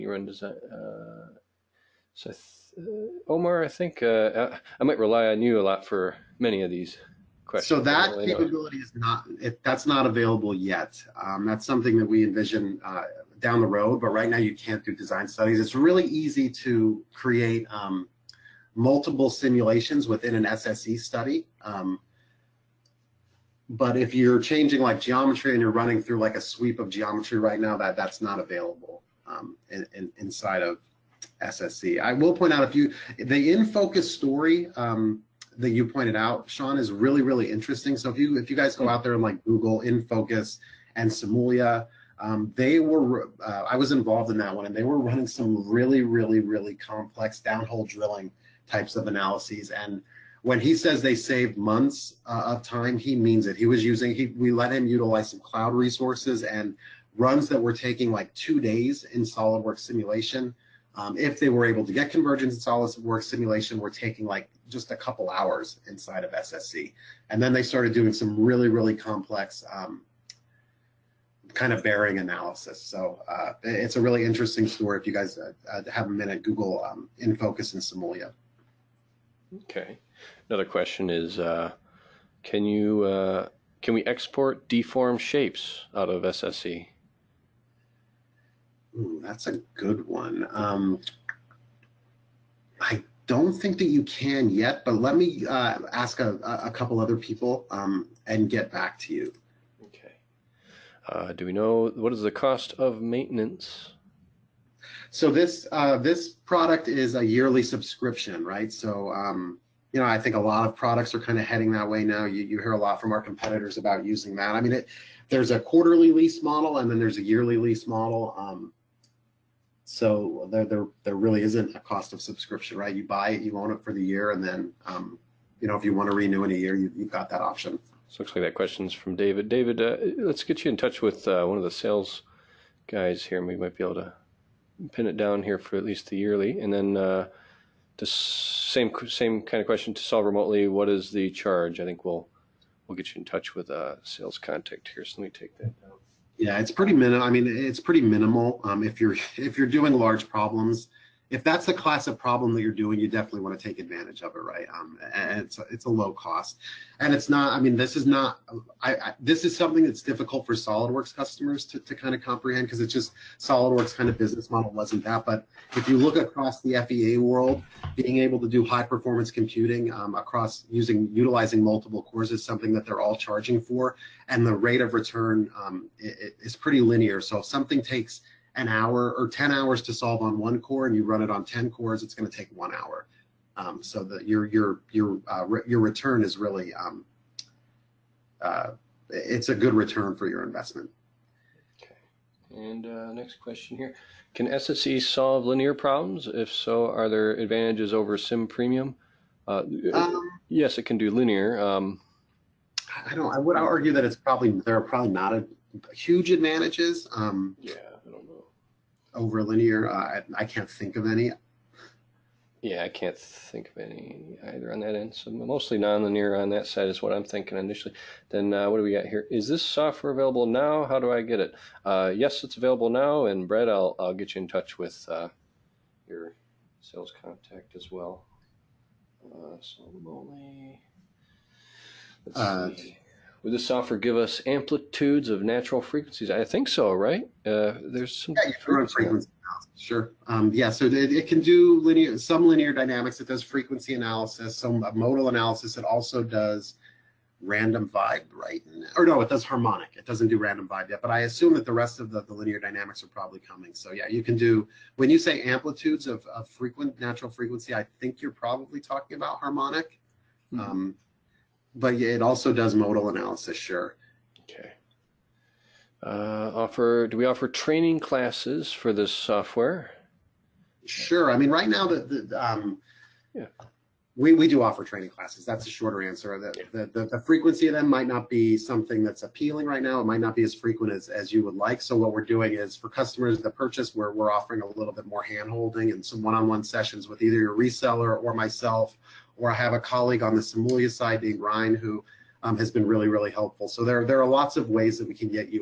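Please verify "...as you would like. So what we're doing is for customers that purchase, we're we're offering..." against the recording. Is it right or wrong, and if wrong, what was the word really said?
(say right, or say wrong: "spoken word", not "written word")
right.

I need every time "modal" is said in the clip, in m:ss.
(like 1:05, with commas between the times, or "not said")
4:04, 4:22.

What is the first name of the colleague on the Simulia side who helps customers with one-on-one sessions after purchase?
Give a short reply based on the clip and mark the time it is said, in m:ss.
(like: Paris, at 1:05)
Ryan, at 4:51.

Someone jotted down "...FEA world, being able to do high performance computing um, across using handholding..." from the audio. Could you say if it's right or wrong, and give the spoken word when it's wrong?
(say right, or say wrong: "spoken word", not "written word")
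wrong: "utilizing", not "handholding".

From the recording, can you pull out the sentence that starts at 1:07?
And then they started doing some really, really complex um, kind of bearing analysis.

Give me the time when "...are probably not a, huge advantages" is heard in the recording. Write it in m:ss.
3:24.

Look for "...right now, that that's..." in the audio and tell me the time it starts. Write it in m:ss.
0:27.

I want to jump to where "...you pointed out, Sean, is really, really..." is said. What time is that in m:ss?
0:35.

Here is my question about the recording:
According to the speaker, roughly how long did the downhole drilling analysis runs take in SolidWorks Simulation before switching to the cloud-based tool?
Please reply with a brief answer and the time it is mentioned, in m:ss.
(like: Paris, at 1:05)
2 days, at 0:58.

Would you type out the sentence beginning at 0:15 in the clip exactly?
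It's really easy to create um, multiple simulations within an SSE study.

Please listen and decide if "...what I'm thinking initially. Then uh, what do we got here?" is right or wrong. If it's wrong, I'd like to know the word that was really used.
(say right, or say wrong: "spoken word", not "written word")
right.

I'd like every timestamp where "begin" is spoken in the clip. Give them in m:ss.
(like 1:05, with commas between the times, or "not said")
not said.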